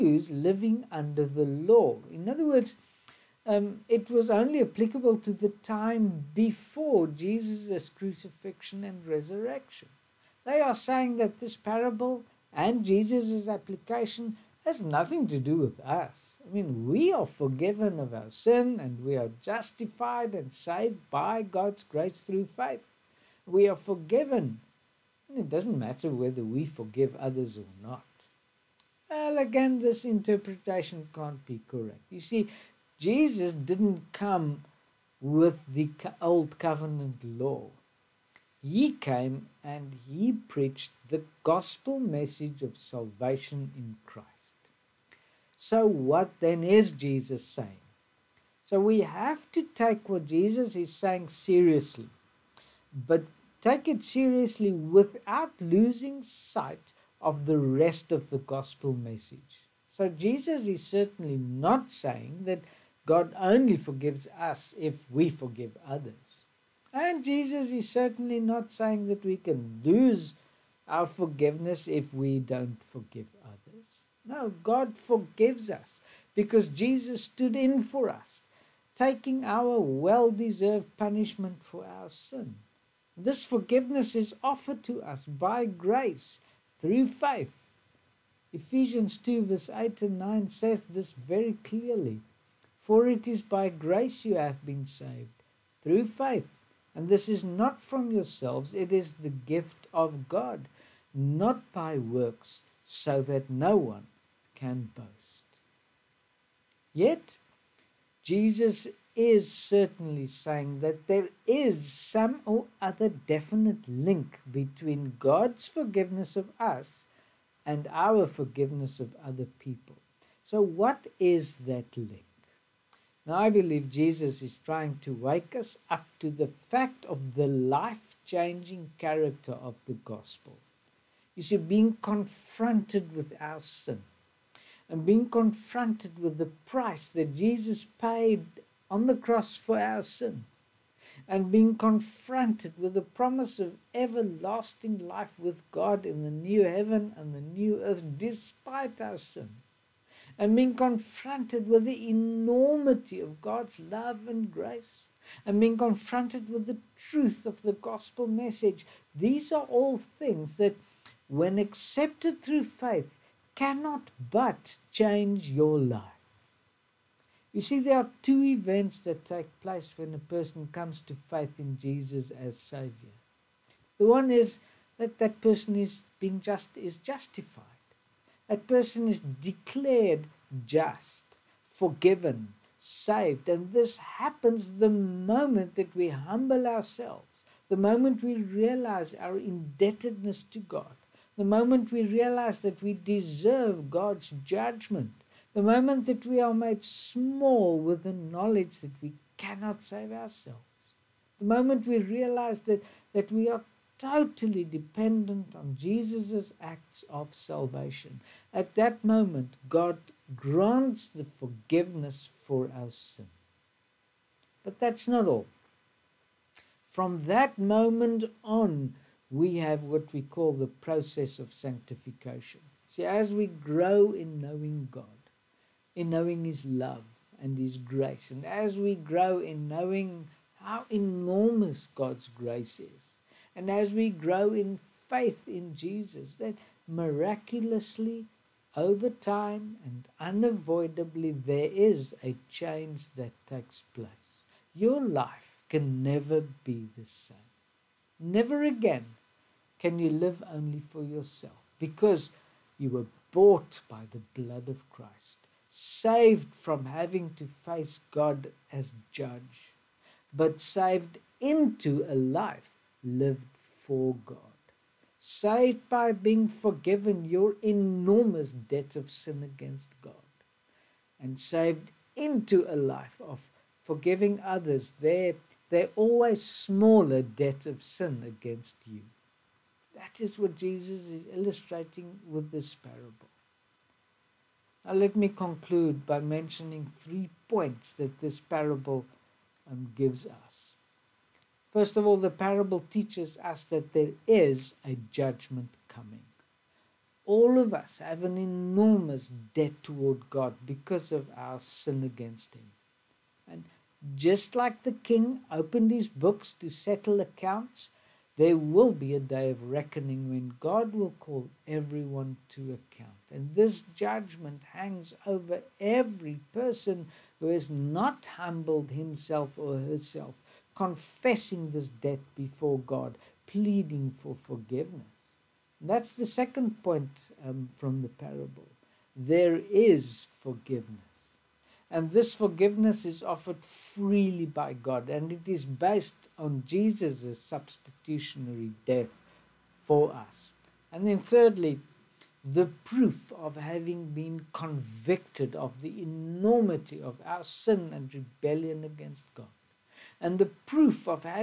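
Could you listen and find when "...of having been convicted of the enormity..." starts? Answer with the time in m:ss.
5:43.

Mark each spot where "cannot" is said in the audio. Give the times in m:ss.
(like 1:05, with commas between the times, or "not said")
2:43, 3:19.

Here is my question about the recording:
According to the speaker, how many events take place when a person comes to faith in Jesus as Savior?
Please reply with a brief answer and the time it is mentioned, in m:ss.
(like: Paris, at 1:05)
2, at 2:48.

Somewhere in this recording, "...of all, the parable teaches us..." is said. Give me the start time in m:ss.
4:51.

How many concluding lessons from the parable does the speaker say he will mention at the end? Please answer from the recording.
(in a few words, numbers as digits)
3.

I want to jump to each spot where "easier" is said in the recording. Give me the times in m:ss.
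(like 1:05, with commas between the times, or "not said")
not said.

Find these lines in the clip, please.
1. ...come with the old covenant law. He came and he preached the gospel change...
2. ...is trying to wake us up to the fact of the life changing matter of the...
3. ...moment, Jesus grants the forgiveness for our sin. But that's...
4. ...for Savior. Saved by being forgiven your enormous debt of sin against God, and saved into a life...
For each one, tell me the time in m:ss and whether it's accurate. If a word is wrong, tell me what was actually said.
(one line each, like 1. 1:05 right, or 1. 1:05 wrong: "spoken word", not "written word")
1. 0:34 wrong: "message", not "change"
2. 2:04 wrong: "character", not "matter"
3. 3:29 wrong: "God", not "Jesus"
4. 4:23 wrong: "God", not "Savior".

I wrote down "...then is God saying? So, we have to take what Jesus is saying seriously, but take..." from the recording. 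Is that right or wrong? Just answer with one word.
wrong.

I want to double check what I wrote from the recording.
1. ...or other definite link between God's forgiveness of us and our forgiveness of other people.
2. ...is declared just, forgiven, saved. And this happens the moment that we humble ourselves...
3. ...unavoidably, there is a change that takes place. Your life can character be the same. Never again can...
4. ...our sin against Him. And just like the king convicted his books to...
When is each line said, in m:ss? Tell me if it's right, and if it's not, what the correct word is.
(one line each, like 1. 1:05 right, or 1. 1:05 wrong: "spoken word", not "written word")
1. 1:52 right
2. 2:59 right
3. 4:00 wrong: "never", not "character"
4. 5:01 wrong: "opened", not "convicted".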